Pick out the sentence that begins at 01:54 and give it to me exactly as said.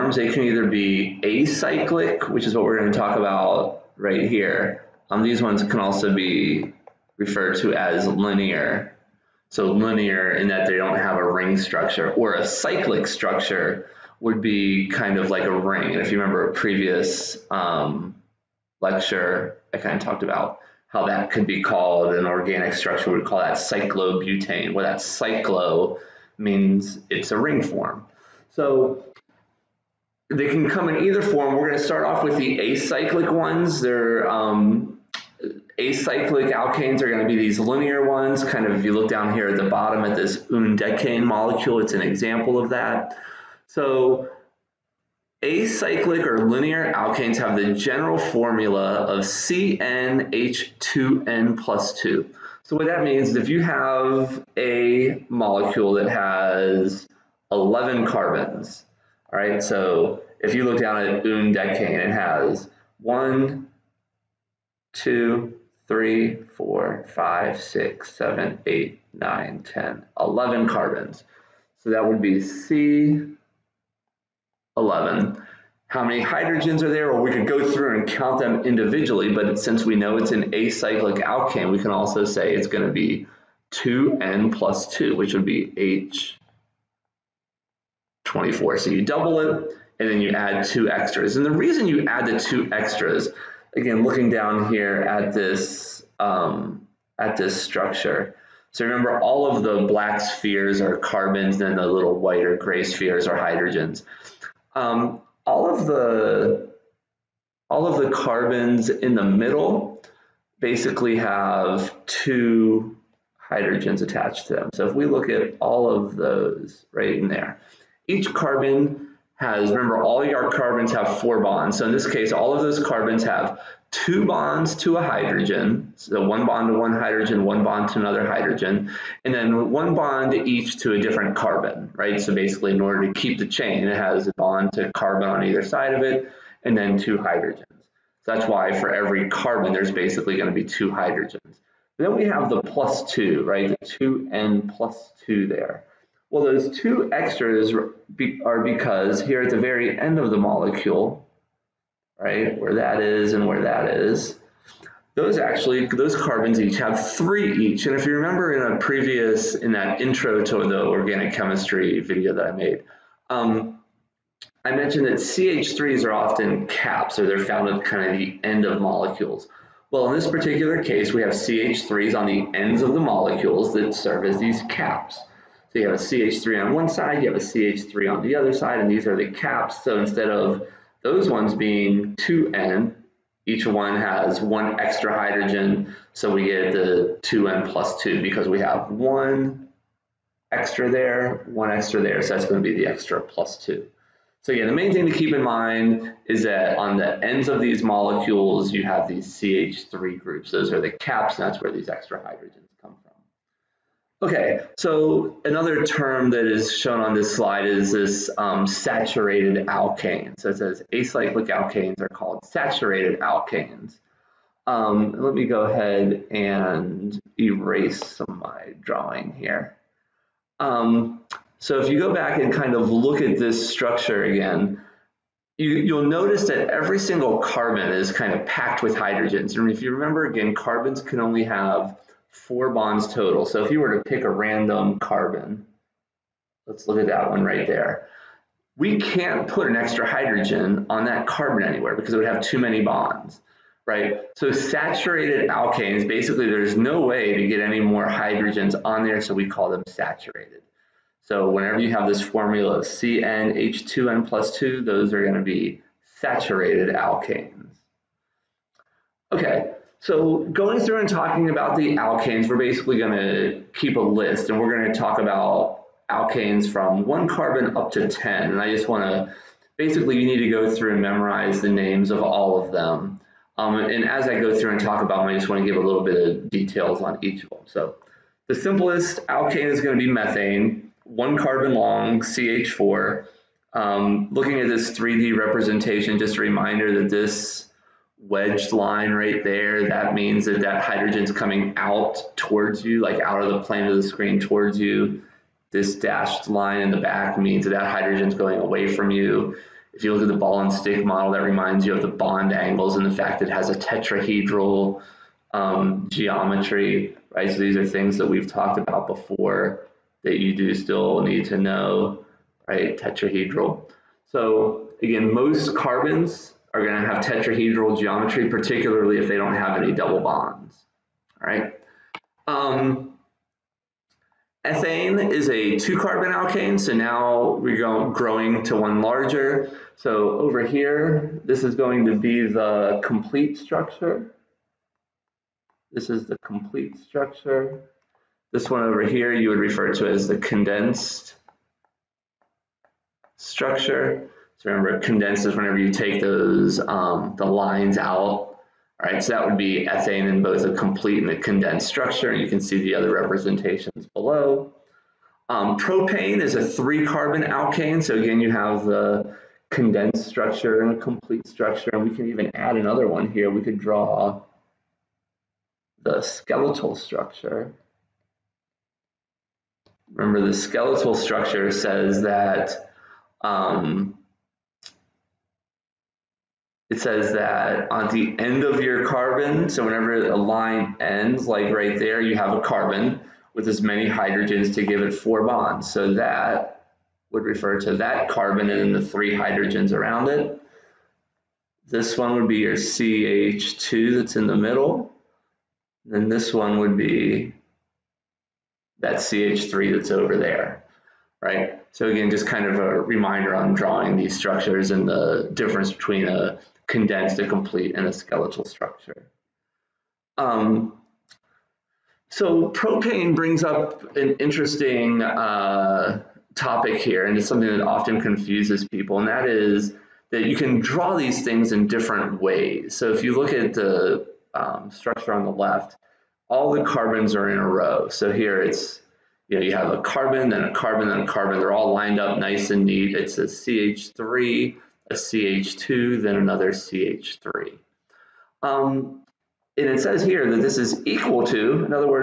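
So if we look at all of those right in there, each carbon has, remember, all your carbons have four bonds.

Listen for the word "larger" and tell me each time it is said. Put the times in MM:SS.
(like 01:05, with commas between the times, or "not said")
05:29.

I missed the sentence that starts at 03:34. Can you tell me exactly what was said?
Um, let me go ahead and erase some of my drawing here.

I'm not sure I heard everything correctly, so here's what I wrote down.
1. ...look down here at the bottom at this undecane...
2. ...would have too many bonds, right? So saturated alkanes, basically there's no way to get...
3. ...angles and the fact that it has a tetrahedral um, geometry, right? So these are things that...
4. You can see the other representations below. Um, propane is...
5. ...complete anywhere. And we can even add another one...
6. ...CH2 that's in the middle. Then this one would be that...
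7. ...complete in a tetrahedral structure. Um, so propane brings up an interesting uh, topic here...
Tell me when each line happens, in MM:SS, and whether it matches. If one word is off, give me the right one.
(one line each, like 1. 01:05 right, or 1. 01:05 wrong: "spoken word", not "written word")
1. 00:38 right
2. 04:02 right
3. 05:02 right
4. 05:52 right
5. 06:01 wrong: "structure", not "anywhere"
6. 06:32 right
7. 06:47 wrong: "skeletal", not "tetrahedral".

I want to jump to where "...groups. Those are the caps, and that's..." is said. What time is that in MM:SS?
03:20.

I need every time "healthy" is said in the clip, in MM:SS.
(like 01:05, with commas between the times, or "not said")
not said.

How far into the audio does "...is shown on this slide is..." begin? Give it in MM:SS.
03:26.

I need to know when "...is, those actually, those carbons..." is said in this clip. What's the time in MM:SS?
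02:33.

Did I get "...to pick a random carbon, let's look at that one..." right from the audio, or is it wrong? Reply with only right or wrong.
right.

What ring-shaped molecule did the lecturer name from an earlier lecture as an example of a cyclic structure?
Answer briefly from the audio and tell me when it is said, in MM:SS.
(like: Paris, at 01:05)
Cyclobutane, at 00:23.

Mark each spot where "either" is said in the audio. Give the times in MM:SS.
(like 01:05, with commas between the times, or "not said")
00:00, 00:31, 02:15.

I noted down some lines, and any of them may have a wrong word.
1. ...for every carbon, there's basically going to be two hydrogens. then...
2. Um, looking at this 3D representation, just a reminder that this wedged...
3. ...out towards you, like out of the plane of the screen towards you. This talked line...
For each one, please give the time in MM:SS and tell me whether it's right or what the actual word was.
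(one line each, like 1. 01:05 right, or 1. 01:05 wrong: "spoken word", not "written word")
1. 02:18 right
2. 04:43 right
3. 04:51 wrong: "dashed", not "talked".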